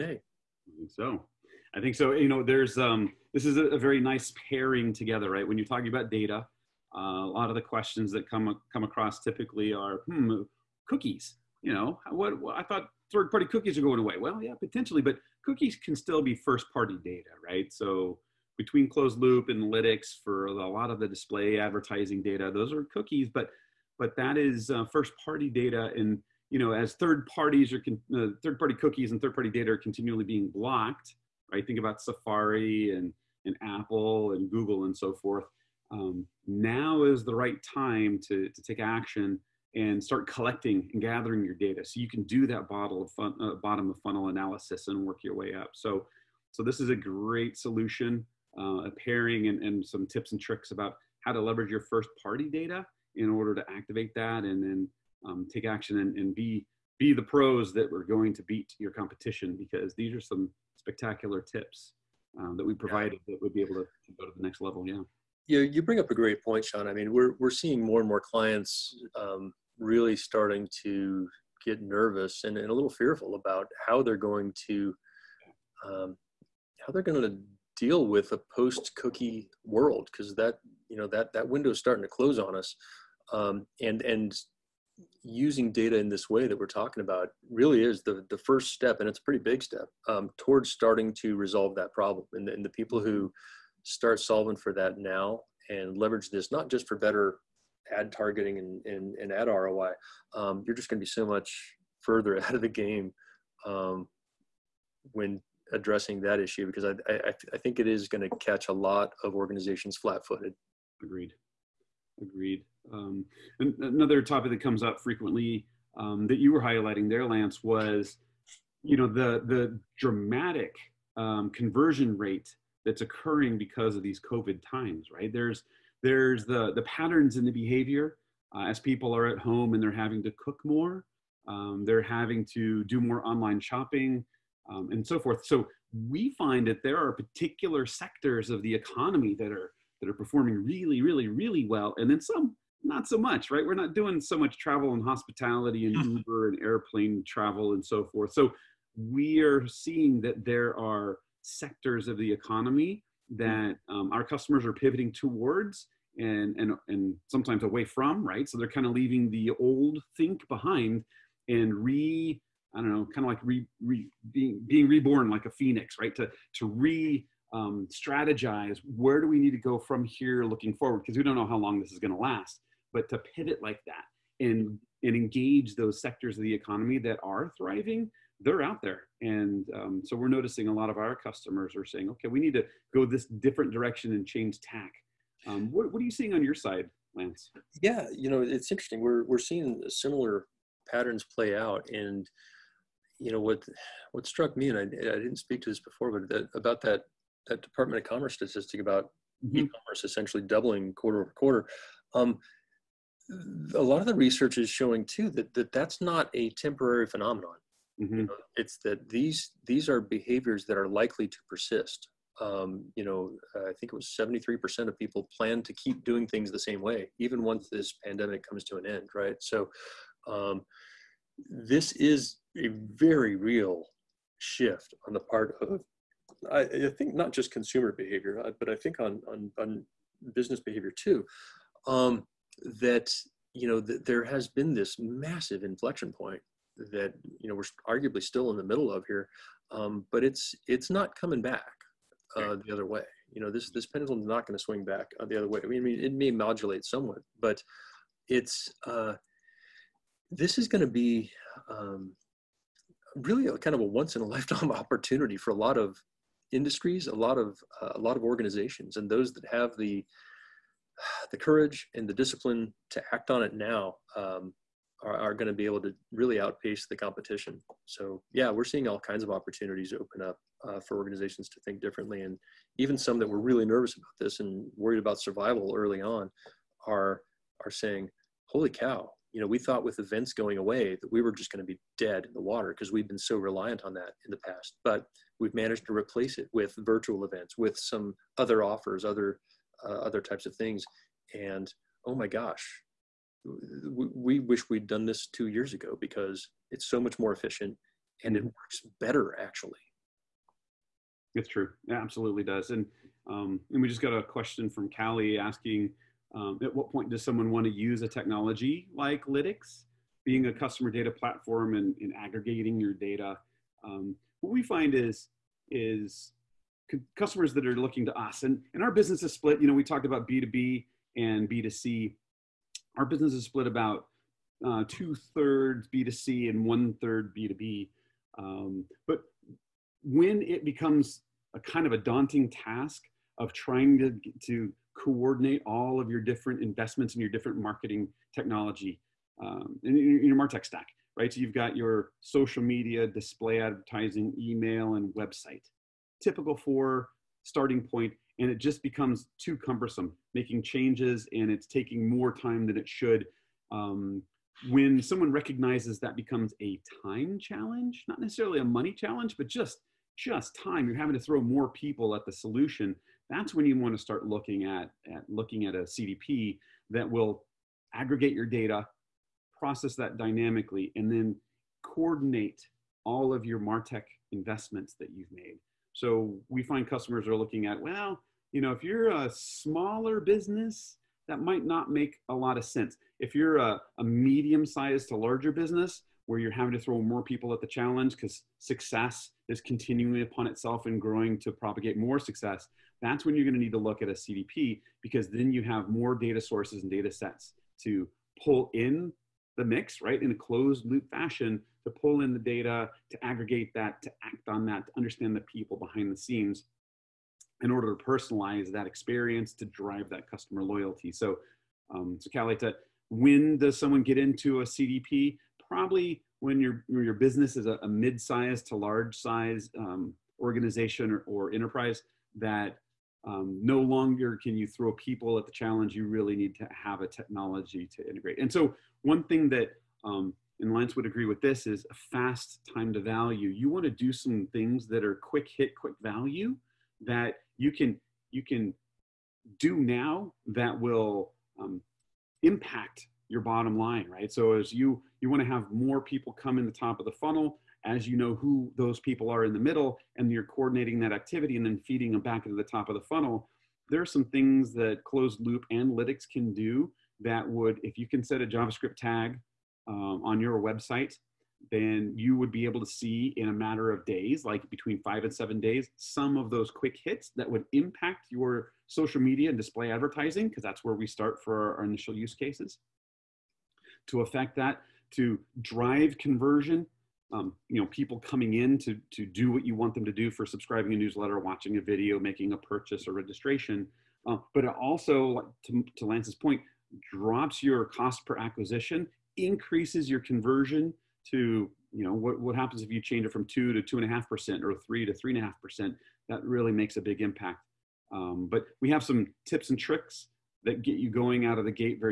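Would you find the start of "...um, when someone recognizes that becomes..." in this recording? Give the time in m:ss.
5:53.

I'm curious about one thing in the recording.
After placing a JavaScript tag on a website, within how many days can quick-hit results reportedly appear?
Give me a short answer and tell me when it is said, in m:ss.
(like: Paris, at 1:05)
5 to 7 days, at 7:45.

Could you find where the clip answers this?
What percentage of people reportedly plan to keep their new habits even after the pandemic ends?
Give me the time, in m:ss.
3:34.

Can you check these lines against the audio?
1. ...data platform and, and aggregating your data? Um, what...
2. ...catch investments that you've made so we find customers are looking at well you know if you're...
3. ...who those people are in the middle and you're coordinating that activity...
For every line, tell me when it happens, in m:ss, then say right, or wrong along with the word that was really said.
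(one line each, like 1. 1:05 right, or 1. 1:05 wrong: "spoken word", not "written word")
1. 5:10 right
2. 6:13 wrong: "martech", not "catch"
3. 7:28 right.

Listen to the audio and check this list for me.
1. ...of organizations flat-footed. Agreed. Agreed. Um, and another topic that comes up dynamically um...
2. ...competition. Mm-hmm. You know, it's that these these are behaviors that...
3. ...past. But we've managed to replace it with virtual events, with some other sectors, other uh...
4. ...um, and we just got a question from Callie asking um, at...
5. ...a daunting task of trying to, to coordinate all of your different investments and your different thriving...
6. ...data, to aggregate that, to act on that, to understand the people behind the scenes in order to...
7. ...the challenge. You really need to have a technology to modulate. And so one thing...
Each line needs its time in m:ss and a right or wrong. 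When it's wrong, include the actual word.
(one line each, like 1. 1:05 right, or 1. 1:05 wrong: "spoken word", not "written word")
1. 1:49 wrong: "frequently", not "dynamically"
2. 3:27 wrong: "phenomenon", not "competition"
3. 4:44 wrong: "offers", not "sectors"
4. 5:03 right
5. 5:31 wrong: "marketing", not "thriving"
6. 6:42 right
7. 7:05 wrong: "integrate", not "modulate".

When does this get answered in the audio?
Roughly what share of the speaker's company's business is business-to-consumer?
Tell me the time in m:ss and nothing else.
5:24.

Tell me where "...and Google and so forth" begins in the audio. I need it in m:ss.
0:34.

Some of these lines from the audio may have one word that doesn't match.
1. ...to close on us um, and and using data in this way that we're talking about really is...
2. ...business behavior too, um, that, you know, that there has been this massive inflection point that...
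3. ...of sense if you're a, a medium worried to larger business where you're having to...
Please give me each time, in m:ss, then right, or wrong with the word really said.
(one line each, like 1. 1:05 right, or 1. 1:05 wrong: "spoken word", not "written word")
1. 1:22 right
2. 3:50 right
3. 6:22 wrong: "sized", not "worried".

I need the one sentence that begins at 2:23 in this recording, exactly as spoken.
We're not doing so much travel and hospitality and mm-hmm.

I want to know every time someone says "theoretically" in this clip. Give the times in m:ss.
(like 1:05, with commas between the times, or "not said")
not said.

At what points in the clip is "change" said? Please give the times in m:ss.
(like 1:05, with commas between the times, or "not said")
3:04, 5:50, 8:13.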